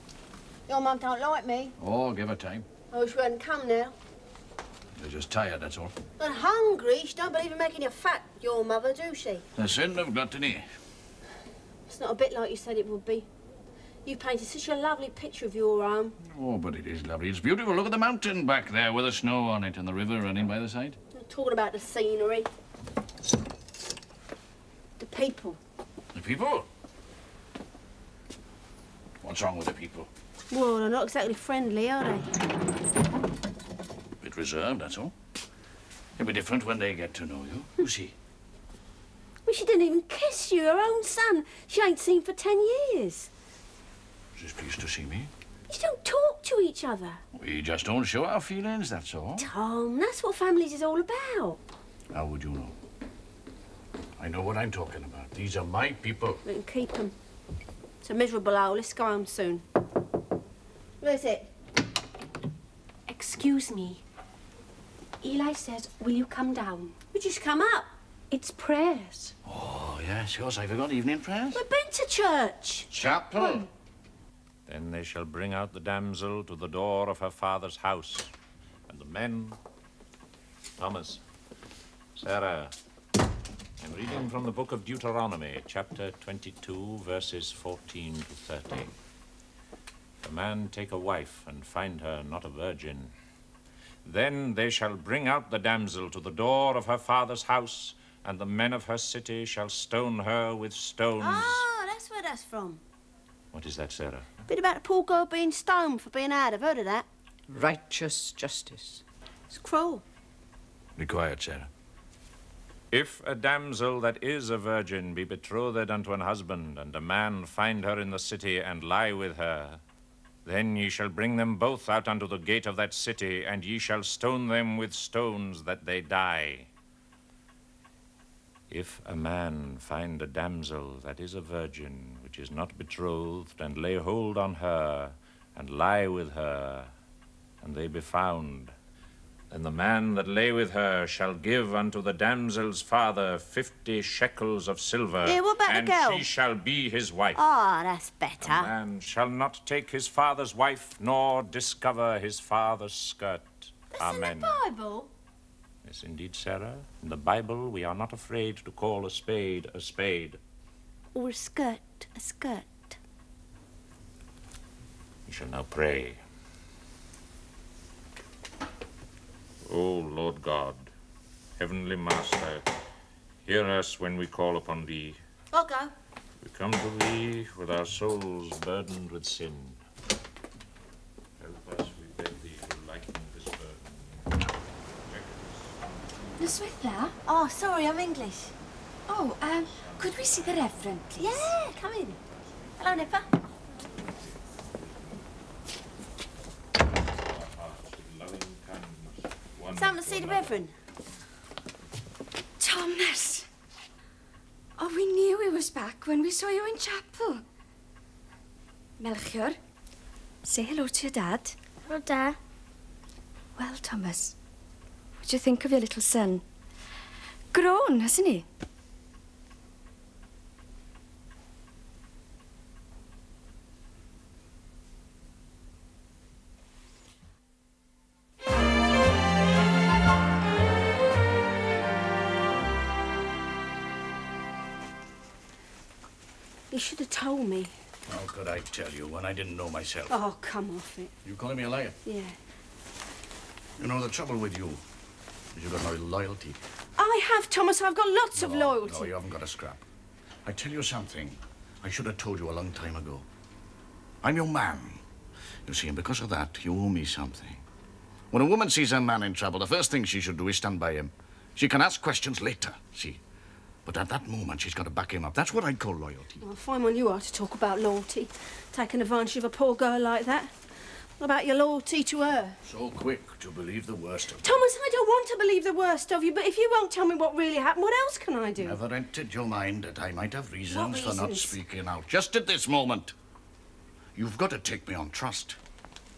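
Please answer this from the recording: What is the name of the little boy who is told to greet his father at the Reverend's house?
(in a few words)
Melchior.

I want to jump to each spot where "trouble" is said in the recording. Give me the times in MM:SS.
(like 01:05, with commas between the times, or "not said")
04:04, 04:19.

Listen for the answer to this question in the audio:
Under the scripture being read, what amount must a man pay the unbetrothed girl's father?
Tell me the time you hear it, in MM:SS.
02:23.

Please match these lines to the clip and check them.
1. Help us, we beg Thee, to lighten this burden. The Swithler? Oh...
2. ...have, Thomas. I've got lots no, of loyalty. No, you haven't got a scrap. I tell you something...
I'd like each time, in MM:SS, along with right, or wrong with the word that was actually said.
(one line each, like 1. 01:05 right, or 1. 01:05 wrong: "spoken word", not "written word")
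1. 03:01 right
2. 04:07 right.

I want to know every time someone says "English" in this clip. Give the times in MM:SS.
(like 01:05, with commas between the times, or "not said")
03:07.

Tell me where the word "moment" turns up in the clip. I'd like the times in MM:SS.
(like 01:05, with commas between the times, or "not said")
04:24, 04:42.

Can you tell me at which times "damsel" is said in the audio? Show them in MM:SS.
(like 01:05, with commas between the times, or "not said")
01:15, 01:35, 01:53, 02:10, 02:22.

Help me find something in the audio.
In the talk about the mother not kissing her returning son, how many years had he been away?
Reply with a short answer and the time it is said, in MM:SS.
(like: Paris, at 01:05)
10, at 00:42.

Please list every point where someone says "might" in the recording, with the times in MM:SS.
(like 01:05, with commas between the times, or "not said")
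04:40.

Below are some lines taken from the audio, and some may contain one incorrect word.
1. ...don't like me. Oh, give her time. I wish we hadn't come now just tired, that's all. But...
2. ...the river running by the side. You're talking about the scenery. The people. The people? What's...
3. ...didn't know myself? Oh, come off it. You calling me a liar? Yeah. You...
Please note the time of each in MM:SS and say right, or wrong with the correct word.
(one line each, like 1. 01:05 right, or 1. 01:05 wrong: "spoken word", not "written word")
1. 00:00 right
2. 00:19 right
3. 03:59 right.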